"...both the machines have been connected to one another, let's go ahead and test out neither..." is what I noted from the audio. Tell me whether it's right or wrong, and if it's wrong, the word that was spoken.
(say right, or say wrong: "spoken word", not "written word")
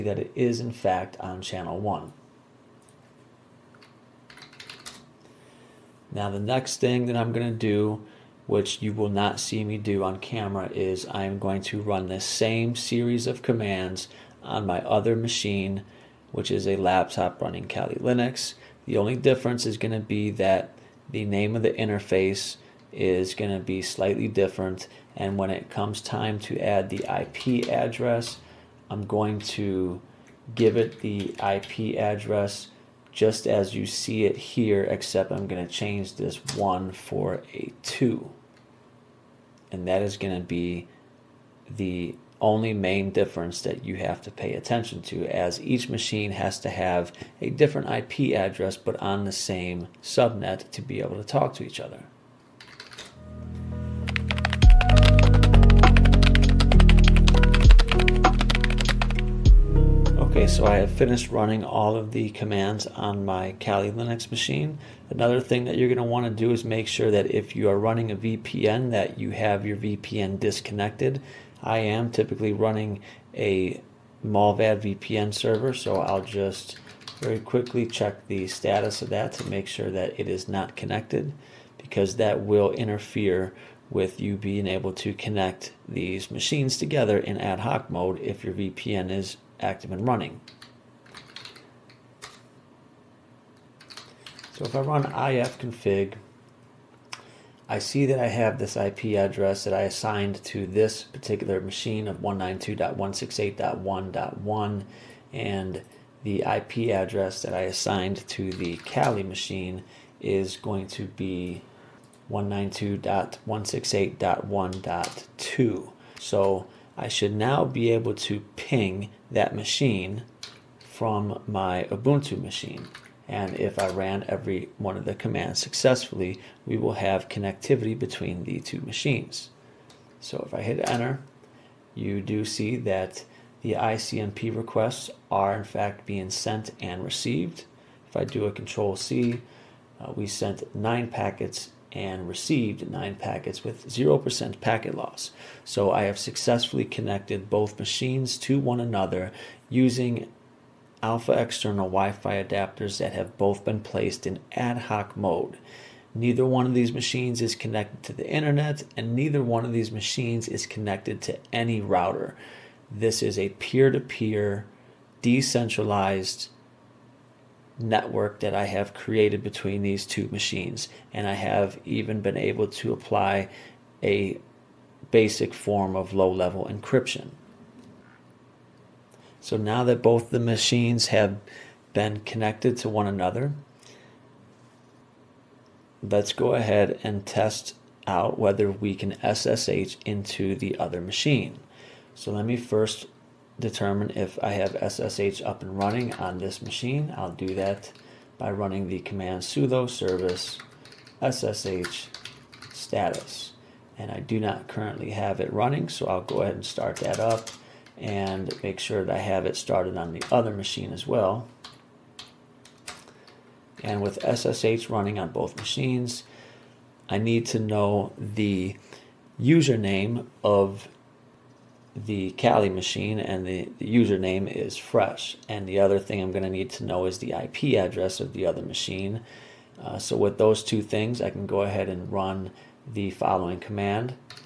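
wrong: "whether", not "neither".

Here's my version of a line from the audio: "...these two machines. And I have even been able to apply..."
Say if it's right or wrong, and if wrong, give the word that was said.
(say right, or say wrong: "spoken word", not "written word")
right.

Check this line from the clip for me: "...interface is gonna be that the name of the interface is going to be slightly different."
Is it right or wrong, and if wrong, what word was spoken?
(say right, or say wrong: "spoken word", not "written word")
wrong: "difference", not "interface".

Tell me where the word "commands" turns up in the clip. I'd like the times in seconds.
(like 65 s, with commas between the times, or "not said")
13 s, 62 s, 125 s, 198 s, 233 s.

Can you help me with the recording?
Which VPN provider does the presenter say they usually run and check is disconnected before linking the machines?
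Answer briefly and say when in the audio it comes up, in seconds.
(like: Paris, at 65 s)
Mullvad, at 74 s.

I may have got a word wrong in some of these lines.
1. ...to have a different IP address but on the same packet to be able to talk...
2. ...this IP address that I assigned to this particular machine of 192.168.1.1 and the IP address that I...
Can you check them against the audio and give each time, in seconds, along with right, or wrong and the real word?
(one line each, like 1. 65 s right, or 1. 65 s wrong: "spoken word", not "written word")
1. 46 s wrong: "subnet", not "packet"
2. 98 s right.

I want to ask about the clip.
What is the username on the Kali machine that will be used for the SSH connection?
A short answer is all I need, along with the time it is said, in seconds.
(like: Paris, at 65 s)
fresh, at 224 s.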